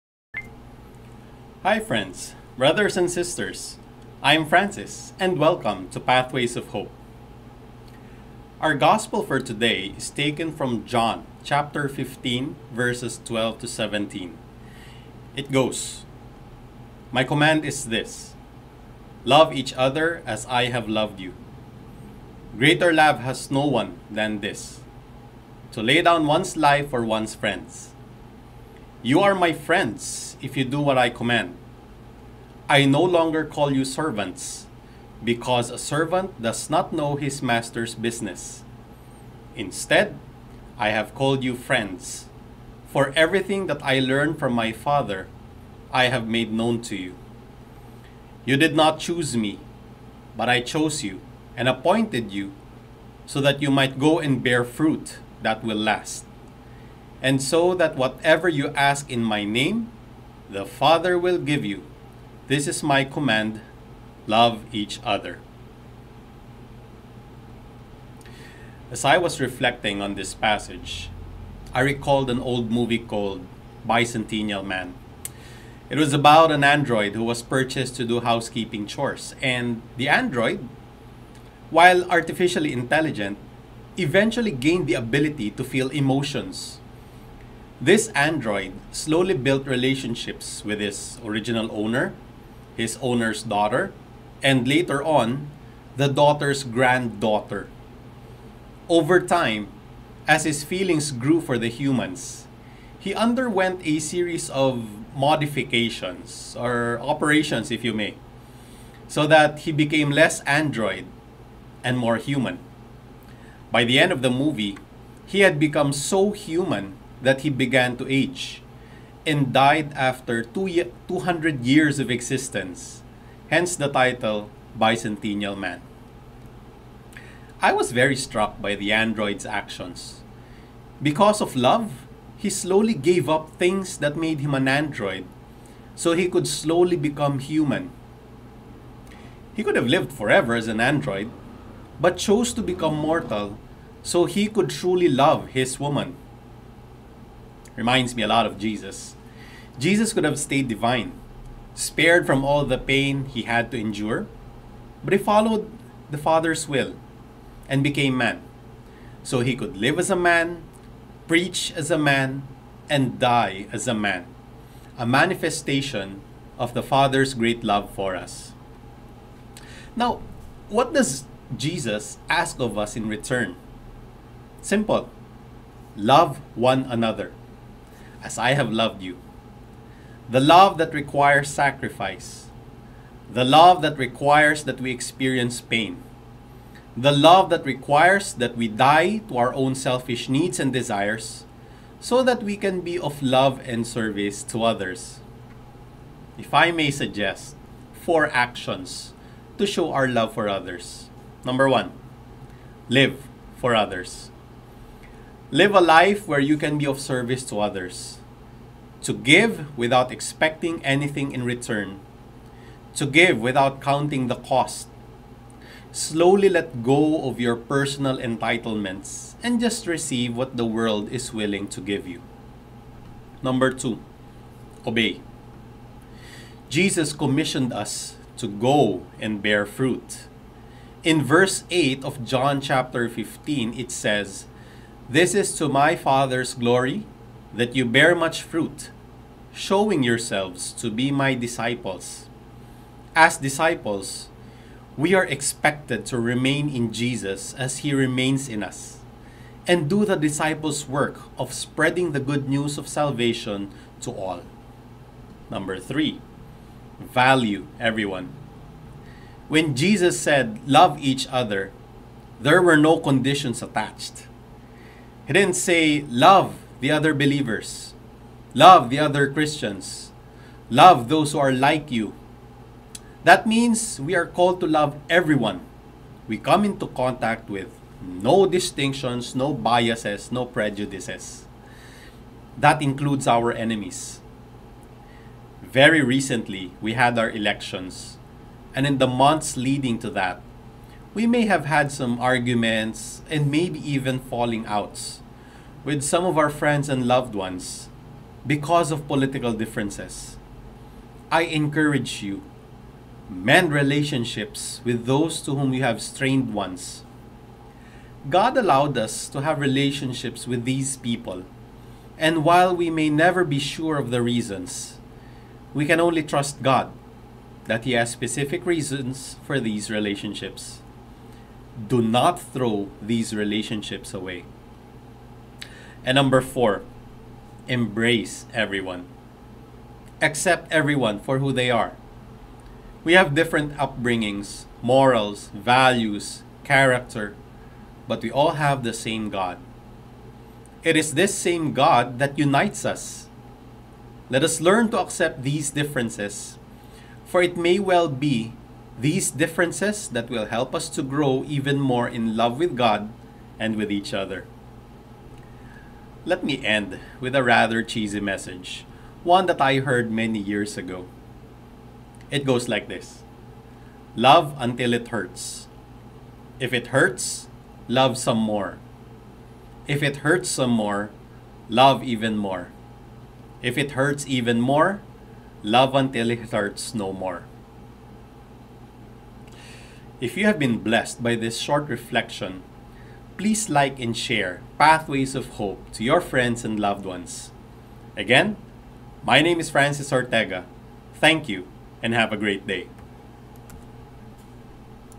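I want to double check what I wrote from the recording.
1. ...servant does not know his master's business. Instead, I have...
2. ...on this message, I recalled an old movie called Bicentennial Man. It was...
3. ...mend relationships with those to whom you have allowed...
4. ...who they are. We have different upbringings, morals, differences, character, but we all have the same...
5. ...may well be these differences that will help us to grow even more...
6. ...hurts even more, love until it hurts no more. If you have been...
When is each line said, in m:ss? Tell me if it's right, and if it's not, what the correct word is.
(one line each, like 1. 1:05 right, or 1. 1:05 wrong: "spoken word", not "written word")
1. 0:35 right
2. 1:10 wrong: "passage", not "message"
3. 5:03 wrong: "strained", not "allowed"
4. 5:31 wrong: "values", not "differences"
5. 5:47 right
6. 6:13 right.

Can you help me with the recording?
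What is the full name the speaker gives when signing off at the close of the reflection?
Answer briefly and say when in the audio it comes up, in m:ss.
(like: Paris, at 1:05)
Francis Ortega, at 6:29.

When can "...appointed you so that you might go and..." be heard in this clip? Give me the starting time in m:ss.
0:51.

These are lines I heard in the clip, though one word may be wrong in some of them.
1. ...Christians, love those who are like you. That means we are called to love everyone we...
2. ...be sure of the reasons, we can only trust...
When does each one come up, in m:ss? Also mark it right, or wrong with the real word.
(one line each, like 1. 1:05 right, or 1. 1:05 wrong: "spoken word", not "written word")
1. 4:29 right
2. 5:13 right.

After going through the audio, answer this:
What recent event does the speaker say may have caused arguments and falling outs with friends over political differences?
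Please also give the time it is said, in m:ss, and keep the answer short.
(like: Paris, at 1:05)
Elections, at 4:47.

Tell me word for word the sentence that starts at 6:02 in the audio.
It goes like this Love until it hurts.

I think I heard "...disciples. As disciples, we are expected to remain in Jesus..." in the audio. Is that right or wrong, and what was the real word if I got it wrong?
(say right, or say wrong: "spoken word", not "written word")
right.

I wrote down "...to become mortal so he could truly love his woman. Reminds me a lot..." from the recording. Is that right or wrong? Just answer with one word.
right.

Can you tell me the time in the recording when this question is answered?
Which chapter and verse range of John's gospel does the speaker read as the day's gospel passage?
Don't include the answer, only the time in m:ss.
0:10.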